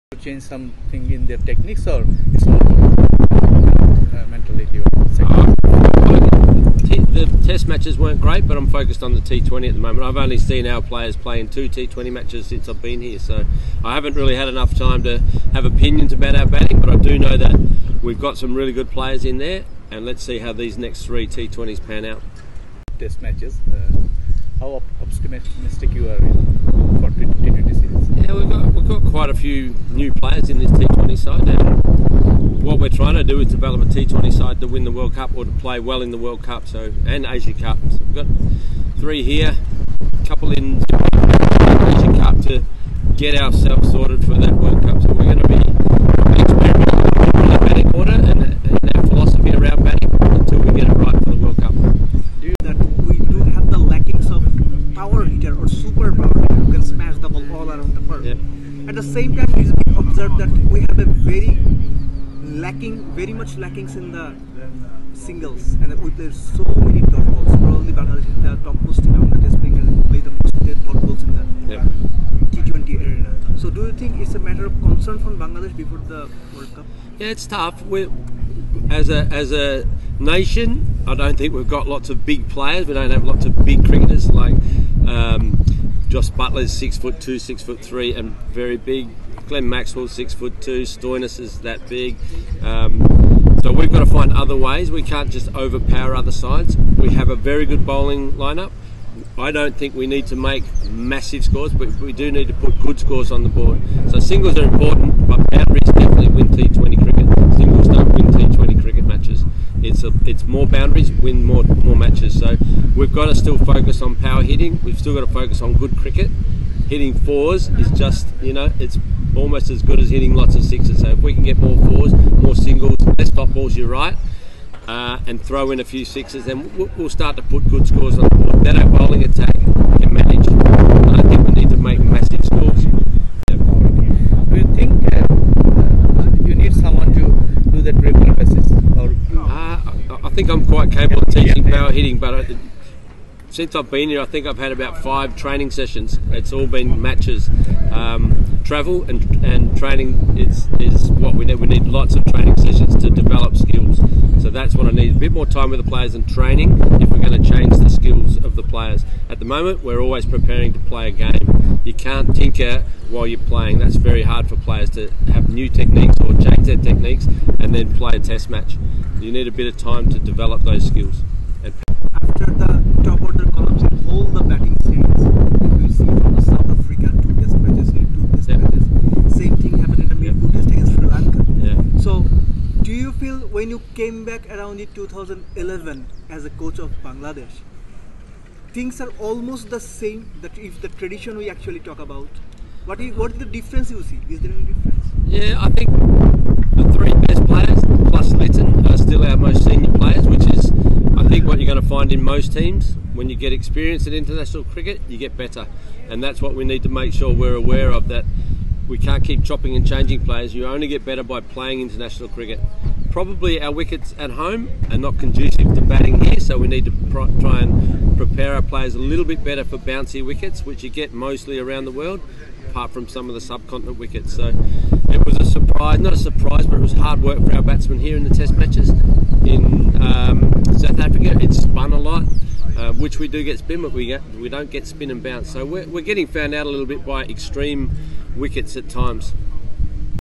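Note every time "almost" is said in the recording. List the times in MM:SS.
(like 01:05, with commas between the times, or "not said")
01:59, 03:09.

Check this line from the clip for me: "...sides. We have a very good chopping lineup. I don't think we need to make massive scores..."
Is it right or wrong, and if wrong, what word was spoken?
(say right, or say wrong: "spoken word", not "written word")
wrong: "bowling", not "chopping".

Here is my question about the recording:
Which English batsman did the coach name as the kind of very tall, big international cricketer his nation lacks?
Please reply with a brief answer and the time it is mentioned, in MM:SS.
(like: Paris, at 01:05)
Jos Buttler, at 01:26.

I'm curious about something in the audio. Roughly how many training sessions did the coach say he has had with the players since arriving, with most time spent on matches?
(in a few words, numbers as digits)
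5.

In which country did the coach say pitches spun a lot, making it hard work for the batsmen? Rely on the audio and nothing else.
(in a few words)
South Africa.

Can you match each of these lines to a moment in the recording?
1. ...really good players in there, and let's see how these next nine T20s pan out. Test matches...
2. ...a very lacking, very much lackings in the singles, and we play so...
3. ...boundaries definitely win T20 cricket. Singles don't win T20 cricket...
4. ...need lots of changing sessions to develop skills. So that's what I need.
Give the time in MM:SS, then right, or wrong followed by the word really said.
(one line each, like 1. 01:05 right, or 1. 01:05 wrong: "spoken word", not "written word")
1. 00:18 wrong: "three", not "nine"
2. 01:00 right
3. 01:45 right
4. 02:31 wrong: "training", not "changing".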